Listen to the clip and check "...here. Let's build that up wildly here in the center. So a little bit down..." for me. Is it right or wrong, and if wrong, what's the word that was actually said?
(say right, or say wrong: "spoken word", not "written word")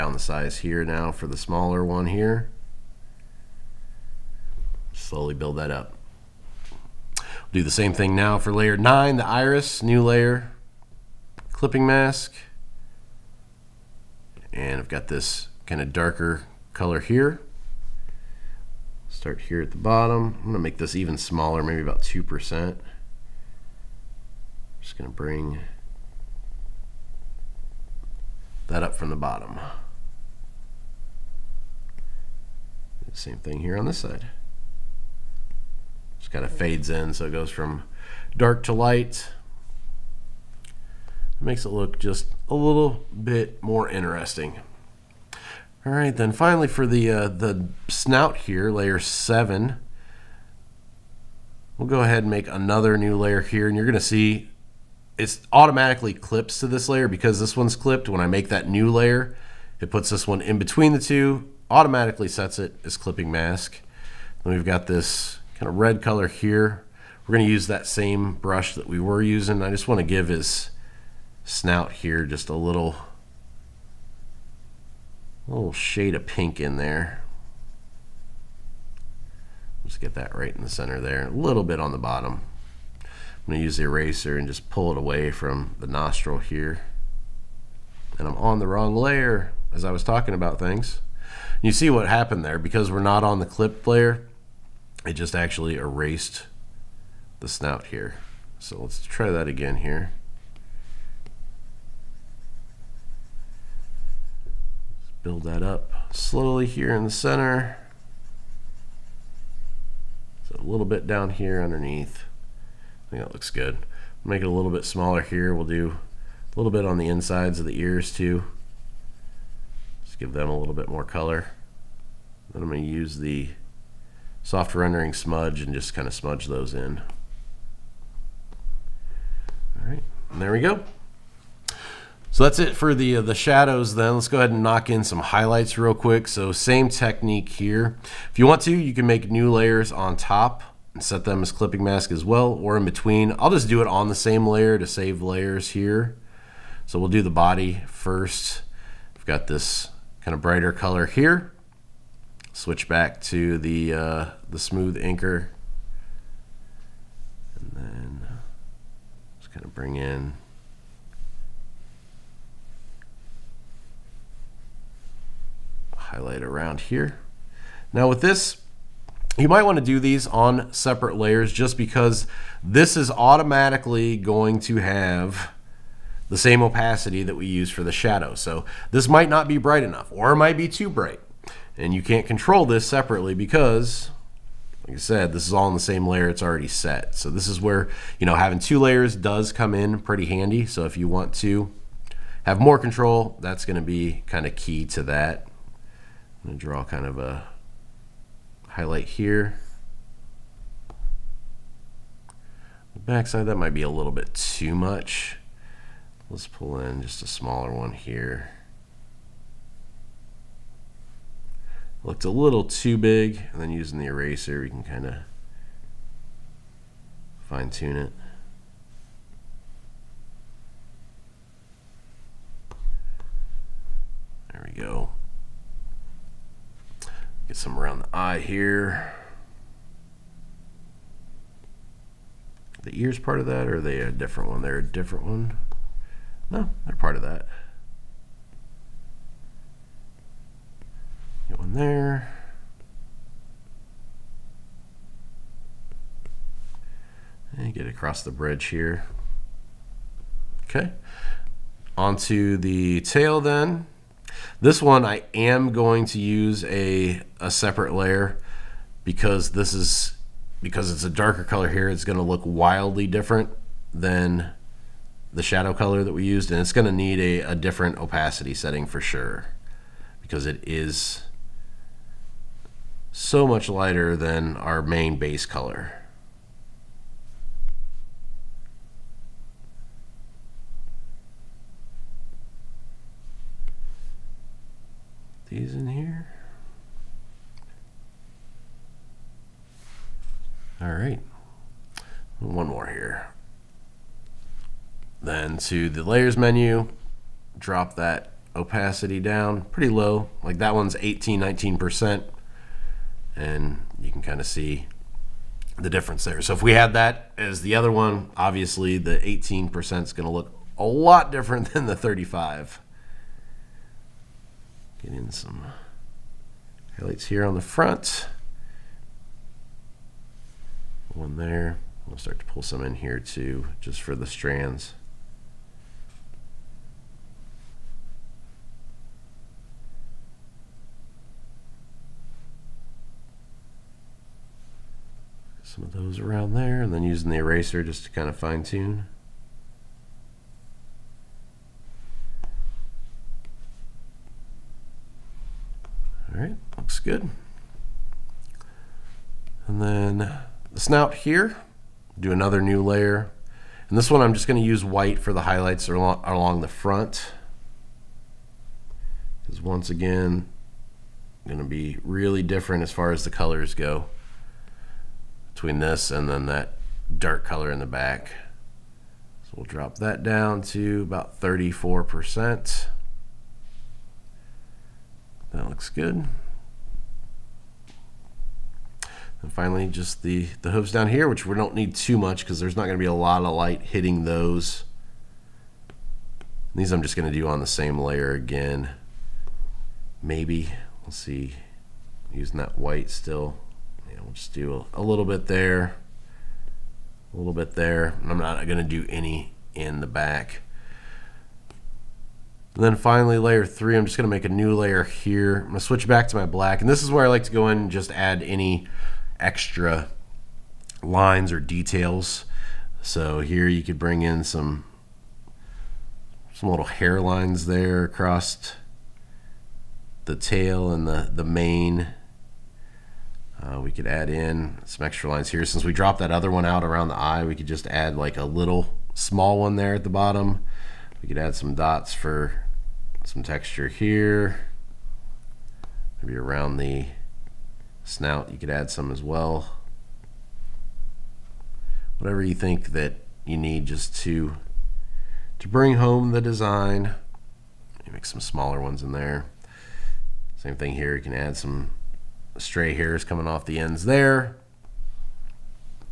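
wrong: "slowly", not "wildly".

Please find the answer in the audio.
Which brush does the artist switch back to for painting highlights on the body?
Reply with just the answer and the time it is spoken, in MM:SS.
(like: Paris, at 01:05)
smooth inker, at 02:34.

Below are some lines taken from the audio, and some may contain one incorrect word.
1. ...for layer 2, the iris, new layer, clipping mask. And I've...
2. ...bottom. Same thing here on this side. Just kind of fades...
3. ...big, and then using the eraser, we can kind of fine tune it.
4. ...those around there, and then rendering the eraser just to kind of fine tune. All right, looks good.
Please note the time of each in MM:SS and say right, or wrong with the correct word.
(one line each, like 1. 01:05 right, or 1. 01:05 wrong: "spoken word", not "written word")
1. 00:08 wrong: "9", not "2"
2. 00:29 right
3. 03:32 right
4. 05:35 wrong: "using", not "rendering".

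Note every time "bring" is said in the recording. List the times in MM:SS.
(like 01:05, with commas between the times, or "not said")
00:25, 02:39, 06:53, 07:25.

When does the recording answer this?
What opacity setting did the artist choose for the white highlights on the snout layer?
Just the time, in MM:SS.
06:11.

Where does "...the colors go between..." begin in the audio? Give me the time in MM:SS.
06:03.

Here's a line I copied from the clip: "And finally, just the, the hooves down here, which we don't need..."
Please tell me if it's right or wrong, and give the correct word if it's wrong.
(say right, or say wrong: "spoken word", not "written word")
right.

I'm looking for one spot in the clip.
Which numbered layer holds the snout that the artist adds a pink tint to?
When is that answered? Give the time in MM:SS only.
00:48.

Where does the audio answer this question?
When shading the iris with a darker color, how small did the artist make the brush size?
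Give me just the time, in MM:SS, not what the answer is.
00:22.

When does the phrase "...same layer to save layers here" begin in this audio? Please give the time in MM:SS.
02:24.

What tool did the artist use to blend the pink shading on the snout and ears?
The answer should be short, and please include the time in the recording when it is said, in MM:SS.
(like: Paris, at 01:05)
soft rendering smudge, at 02:04.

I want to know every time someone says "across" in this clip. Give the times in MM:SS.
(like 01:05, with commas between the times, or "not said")
04:07, 06:58.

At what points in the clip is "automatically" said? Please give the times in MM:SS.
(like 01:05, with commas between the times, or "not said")
00:55, 01:01, 02:53.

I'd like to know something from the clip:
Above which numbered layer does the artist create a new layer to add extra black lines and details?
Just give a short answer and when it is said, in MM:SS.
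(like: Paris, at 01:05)
Layer 3, at 06:43.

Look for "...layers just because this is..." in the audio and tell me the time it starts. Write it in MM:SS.
02:51.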